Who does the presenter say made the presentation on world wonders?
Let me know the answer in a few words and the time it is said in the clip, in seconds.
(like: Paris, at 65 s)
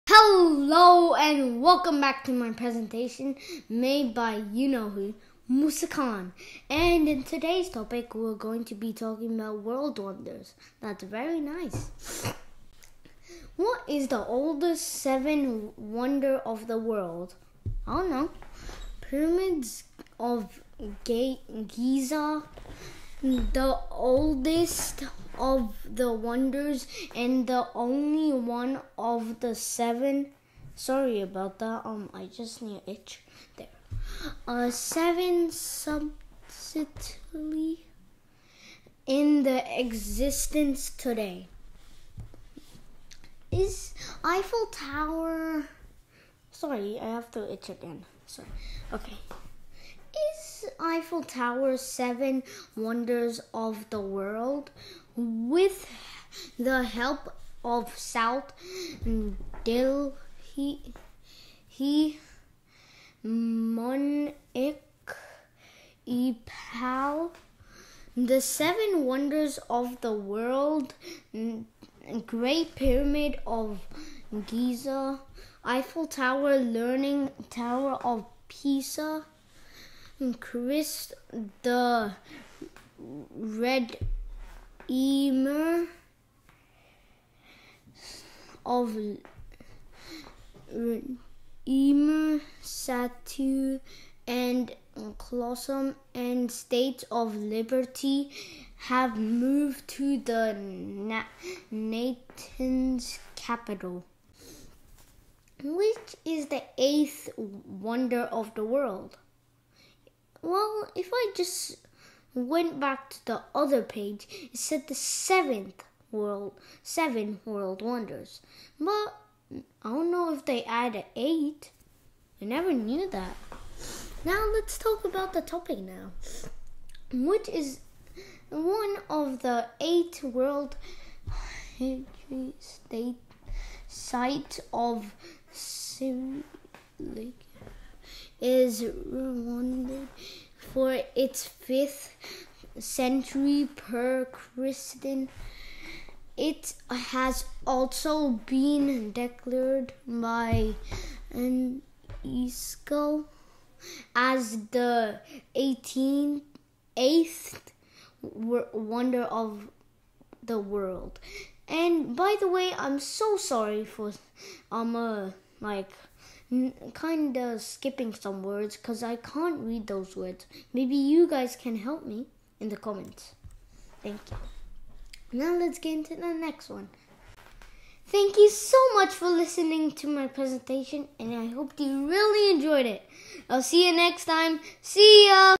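Musa Khan, at 5 s.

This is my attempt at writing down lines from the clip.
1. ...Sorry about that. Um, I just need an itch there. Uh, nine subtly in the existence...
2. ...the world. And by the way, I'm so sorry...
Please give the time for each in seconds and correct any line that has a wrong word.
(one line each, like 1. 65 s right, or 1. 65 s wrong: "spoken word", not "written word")
1. 30 s wrong: "seven", not "nine"
2. 160 s right.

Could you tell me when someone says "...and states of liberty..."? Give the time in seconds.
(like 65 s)
96 s.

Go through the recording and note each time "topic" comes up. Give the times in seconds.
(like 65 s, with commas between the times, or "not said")
7 s, 125 s.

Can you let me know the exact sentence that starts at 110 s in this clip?
Well, if I just went back to the other page, it said the seventh world, seven world wonders.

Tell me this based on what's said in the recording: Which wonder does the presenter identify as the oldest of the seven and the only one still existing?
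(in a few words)
Pyramids of Giza.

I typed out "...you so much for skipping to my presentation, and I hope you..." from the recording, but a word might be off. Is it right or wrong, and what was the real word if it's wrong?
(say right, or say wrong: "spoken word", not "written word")
wrong: "listening", not "skipping".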